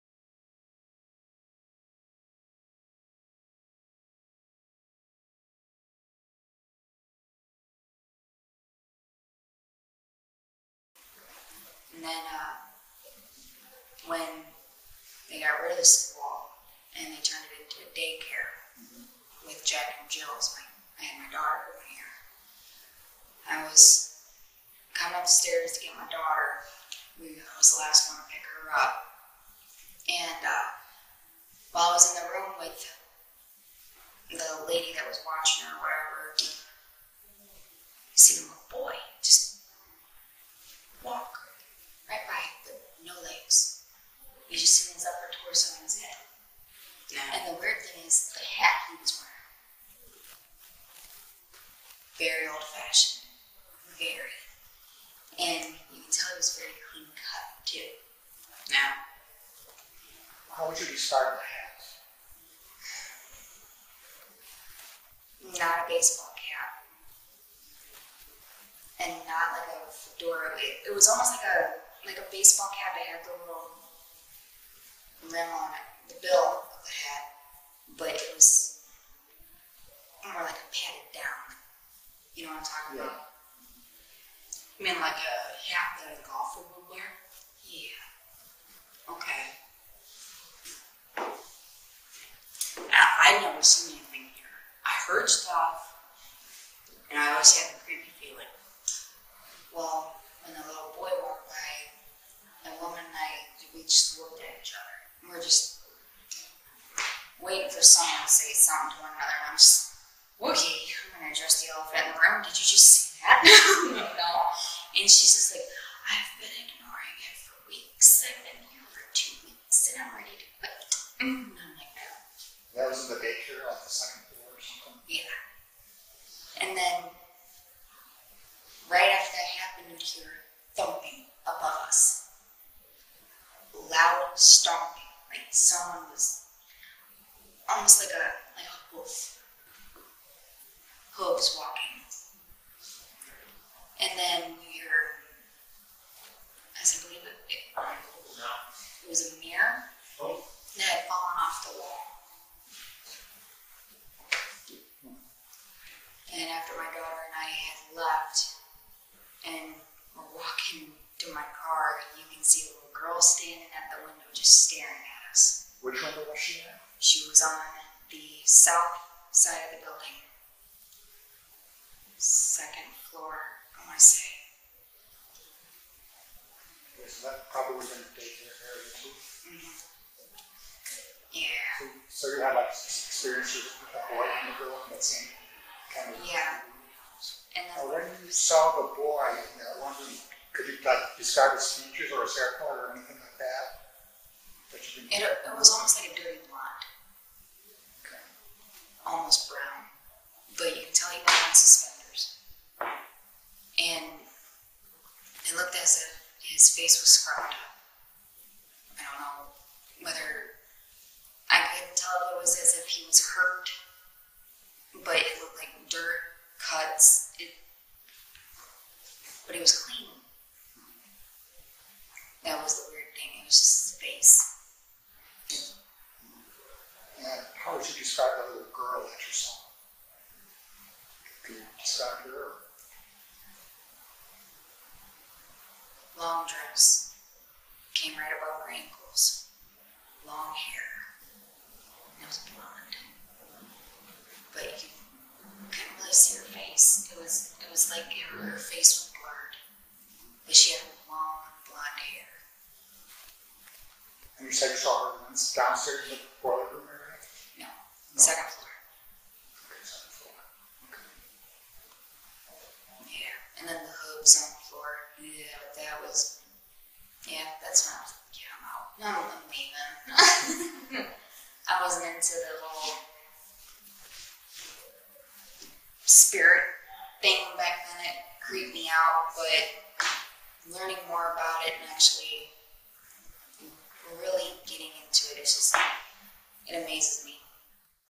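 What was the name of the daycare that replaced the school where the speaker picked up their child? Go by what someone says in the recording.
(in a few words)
Jack and Jill's.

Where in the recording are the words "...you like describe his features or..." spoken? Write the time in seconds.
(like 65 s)
190 s.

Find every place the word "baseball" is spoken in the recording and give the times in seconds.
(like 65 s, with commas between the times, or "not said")
65 s, 72 s.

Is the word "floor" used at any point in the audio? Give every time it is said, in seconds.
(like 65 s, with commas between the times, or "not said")
124 s, 173 s, 259 s, 264 s.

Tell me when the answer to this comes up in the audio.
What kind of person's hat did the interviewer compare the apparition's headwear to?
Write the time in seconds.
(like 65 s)
86 s.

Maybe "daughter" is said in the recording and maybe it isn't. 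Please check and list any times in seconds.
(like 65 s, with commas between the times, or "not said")
21 s, 26 s, 156 s.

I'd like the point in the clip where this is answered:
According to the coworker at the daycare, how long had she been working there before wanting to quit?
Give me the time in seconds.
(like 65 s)
119 s.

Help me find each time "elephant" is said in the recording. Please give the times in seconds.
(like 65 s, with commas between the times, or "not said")
111 s.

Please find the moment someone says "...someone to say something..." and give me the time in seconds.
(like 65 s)
107 s.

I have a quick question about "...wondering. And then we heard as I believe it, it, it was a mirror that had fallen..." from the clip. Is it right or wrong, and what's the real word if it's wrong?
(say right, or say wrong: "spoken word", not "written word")
wrong: "walking", not "wondering".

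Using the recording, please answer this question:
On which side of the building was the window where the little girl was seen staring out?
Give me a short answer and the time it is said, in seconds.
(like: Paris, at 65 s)
South side, at 168 s.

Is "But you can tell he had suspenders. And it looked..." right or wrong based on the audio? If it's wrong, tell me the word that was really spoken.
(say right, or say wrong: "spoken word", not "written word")
right.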